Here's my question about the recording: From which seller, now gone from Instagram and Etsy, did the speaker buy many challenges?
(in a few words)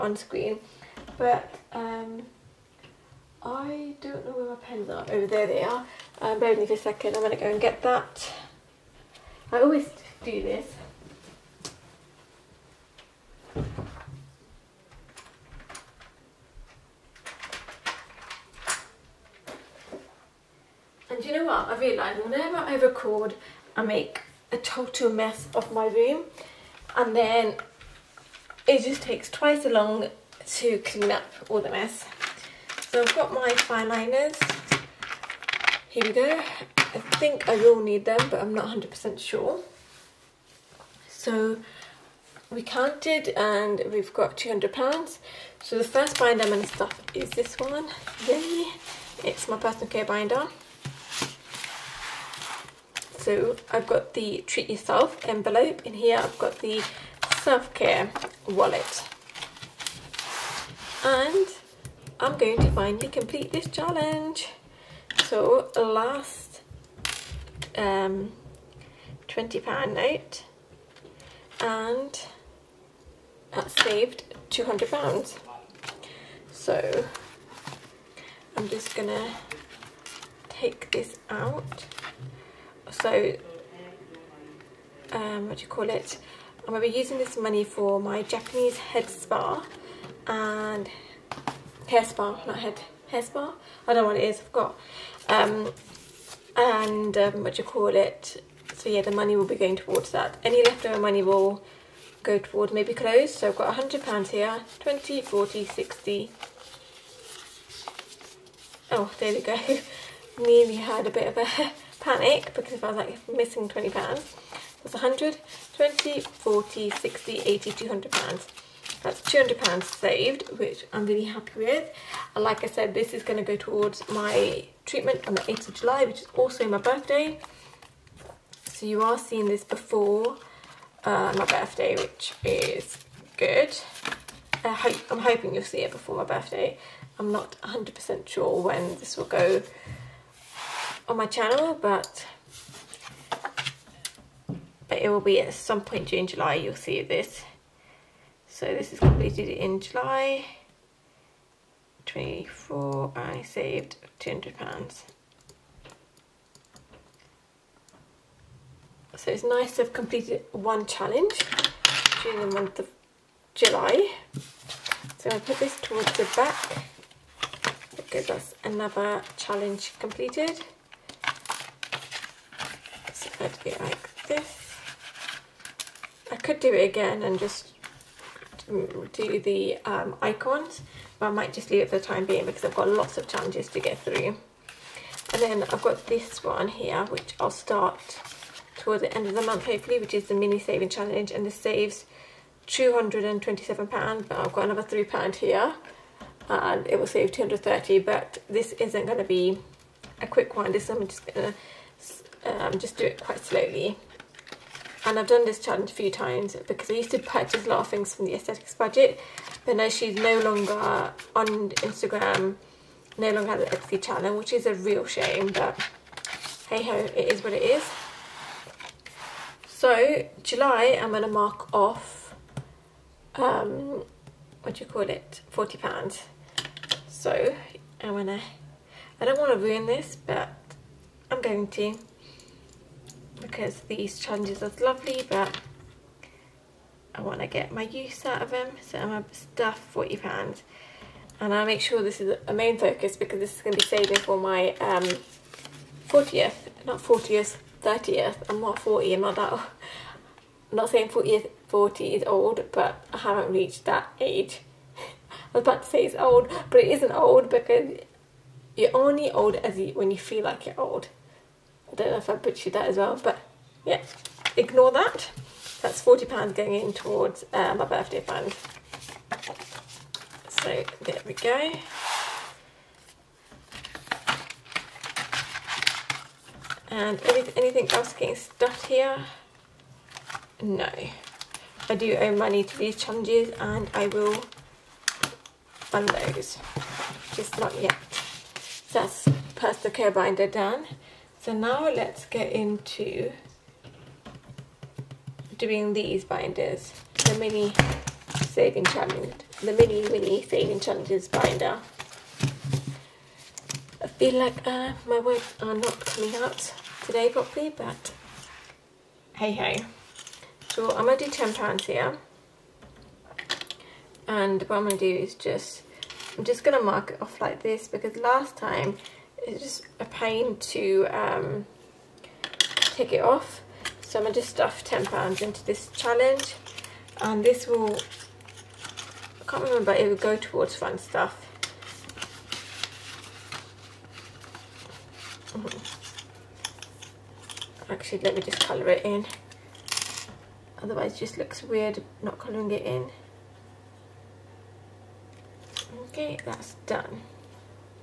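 The aesthetics budget.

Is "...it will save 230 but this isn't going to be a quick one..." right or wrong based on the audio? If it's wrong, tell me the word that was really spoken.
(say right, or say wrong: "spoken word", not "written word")
right.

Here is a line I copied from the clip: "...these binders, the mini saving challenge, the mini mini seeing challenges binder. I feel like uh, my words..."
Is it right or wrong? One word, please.
wrong.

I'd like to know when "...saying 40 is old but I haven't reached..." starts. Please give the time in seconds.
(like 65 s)
250 s.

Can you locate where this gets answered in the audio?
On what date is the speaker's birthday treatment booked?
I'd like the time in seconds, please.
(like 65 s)
125 s.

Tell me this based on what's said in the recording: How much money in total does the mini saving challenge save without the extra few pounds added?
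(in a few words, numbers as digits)
£227.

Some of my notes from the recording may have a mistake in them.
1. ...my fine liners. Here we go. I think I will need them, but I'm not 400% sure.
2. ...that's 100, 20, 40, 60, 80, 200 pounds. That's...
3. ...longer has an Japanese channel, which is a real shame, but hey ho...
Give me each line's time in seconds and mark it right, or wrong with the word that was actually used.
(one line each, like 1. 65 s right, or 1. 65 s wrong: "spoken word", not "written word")
1. 33 s wrong: "100", not "400"
2. 113 s right
3. 213 s wrong: "Etsy", not "Japanese".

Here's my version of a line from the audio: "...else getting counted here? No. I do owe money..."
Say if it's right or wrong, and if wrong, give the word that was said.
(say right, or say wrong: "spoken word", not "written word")
wrong: "stuffed", not "counted".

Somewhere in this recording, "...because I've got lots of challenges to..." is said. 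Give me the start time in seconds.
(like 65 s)
182 s.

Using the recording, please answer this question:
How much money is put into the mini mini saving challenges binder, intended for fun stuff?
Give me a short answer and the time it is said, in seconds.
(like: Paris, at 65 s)
£10, at 311 s.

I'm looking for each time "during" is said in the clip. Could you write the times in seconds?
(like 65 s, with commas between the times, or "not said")
146 s, 162 s.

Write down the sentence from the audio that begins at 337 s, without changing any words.
Actually, let me just colour it in.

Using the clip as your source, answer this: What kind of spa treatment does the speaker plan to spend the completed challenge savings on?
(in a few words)
Japanese head spa.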